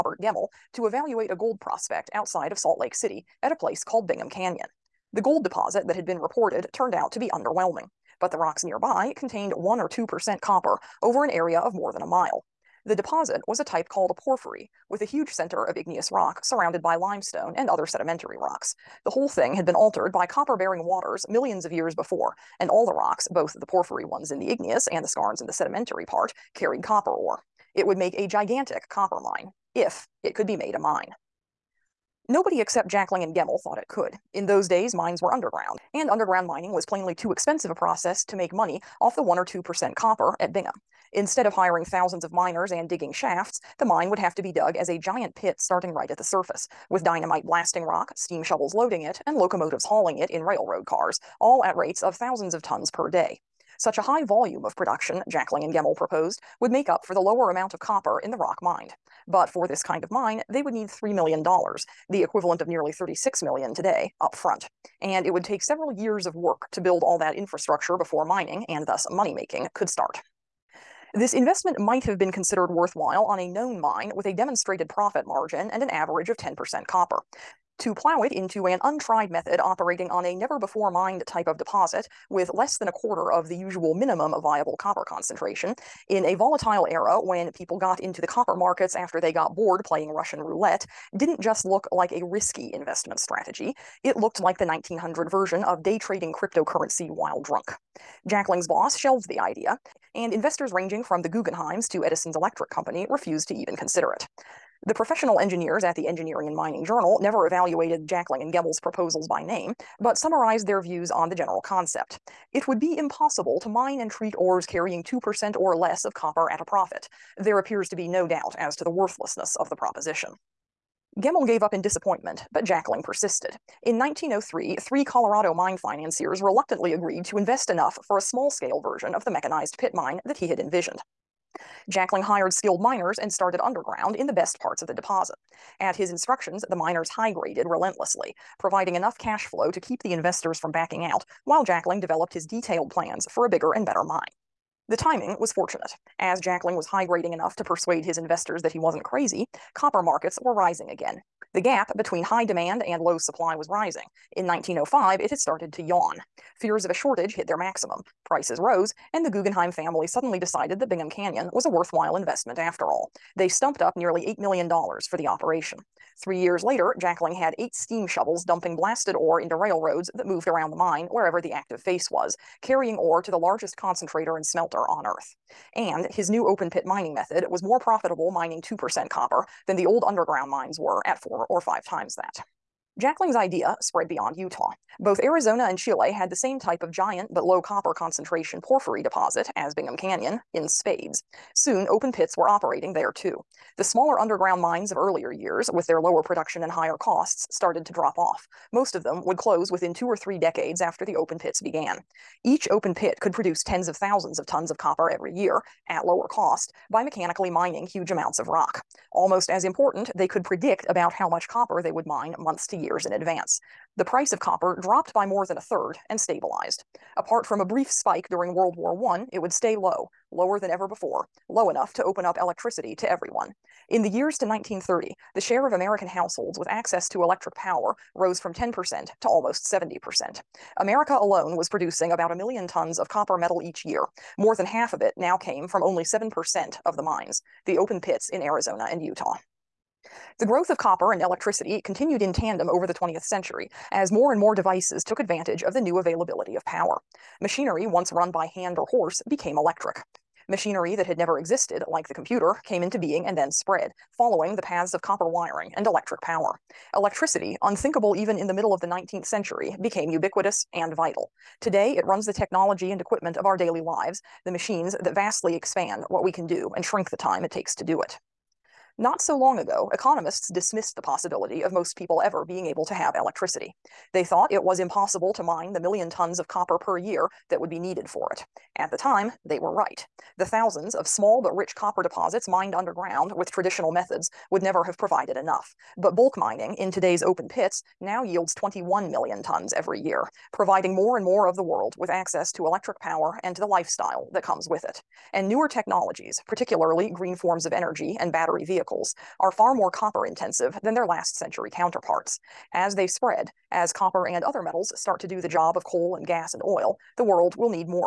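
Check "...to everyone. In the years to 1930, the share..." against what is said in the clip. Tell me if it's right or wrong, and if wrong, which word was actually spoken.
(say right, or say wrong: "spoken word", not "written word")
right.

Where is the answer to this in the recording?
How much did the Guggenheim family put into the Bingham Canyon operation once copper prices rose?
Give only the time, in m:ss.
2:43.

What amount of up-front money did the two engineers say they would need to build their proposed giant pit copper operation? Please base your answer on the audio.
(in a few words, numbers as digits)
$3 million.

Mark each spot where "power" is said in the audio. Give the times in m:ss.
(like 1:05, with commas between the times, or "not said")
3:47, 4:06, 4:16, 4:52.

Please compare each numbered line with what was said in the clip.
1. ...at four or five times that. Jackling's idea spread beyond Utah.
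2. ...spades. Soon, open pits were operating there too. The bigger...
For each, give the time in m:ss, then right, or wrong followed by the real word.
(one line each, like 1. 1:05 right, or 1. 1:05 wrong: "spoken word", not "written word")
1. 3:01 right
2. 3:10 wrong: "smaller", not "bigger".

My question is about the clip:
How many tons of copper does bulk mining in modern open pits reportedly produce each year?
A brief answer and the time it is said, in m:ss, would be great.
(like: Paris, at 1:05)
21 million, at 4:48.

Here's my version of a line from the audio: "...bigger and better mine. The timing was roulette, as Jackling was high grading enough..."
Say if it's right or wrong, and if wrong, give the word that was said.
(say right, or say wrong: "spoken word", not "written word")
wrong: "fortunate", not "roulette".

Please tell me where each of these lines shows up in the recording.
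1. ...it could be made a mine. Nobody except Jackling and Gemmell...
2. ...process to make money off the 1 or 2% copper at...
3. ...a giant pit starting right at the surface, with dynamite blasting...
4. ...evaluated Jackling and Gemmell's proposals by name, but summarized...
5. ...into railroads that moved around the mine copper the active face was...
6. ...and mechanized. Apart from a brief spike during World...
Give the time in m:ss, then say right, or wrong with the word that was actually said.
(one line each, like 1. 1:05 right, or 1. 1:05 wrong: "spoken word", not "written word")
1. 0:30 right
2. 0:37 right
3. 0:44 right
4. 1:47 right
5. 2:49 wrong: "wherever", not "copper"
6. 3:36 wrong: "stabilized", not "mechanized".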